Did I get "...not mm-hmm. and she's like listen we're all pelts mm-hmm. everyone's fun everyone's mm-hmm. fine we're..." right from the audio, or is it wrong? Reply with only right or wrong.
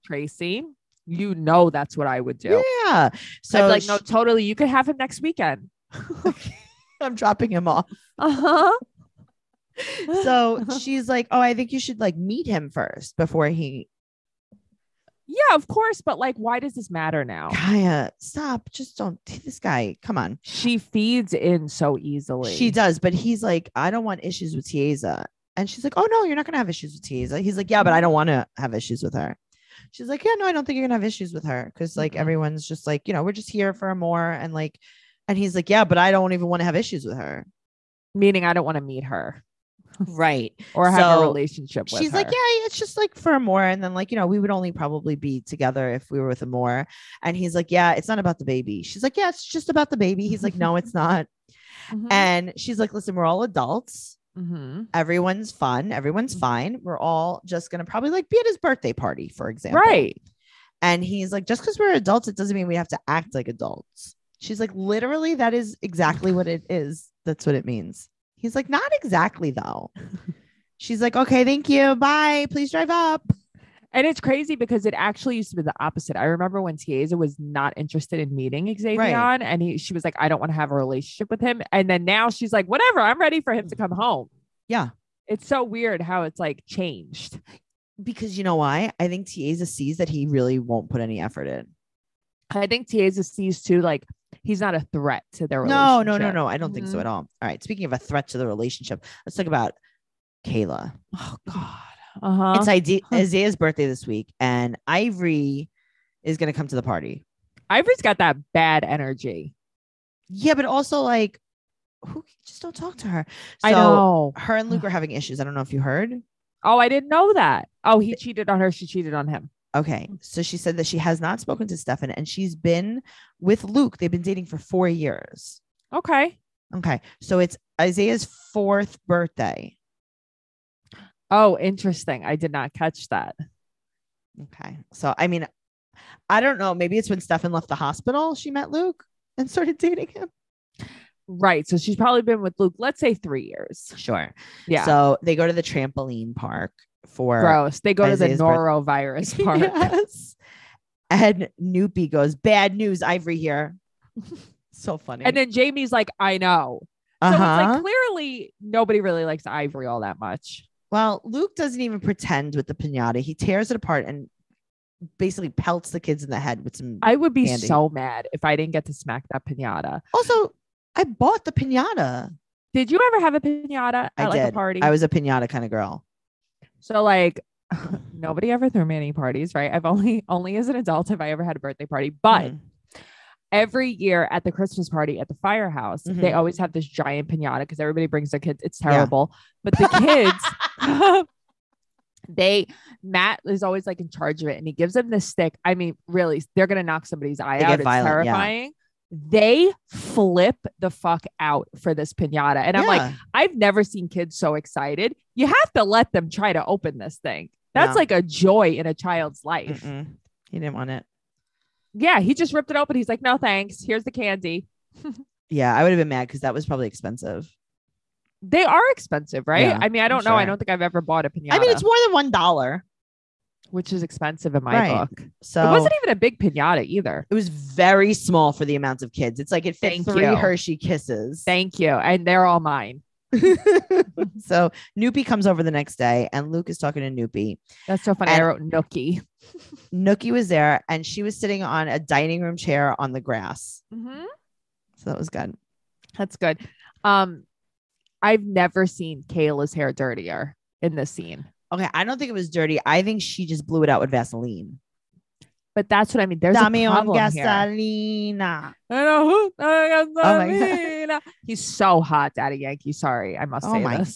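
wrong.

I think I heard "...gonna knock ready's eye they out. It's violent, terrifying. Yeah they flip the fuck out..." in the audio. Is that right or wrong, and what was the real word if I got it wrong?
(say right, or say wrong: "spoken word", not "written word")
wrong: "somebody", not "ready".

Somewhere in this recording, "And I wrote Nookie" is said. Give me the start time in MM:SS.
03:58.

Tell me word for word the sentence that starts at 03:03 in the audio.
Every year at the Christmas party at the firehouse, mm-hmm.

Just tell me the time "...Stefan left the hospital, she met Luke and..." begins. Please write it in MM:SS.
02:17.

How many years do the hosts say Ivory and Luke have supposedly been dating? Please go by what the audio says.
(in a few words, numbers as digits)
4.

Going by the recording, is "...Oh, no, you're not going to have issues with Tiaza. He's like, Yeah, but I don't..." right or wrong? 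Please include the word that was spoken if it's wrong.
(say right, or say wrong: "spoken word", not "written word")
right.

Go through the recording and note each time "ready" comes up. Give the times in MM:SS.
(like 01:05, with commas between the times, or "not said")
01:23.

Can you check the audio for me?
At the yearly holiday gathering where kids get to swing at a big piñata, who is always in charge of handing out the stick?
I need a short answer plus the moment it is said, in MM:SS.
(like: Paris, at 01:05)
Matt, at 03:13.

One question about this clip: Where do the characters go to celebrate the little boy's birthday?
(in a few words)
trampoline park.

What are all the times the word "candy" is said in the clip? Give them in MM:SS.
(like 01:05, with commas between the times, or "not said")
02:47, 03:34.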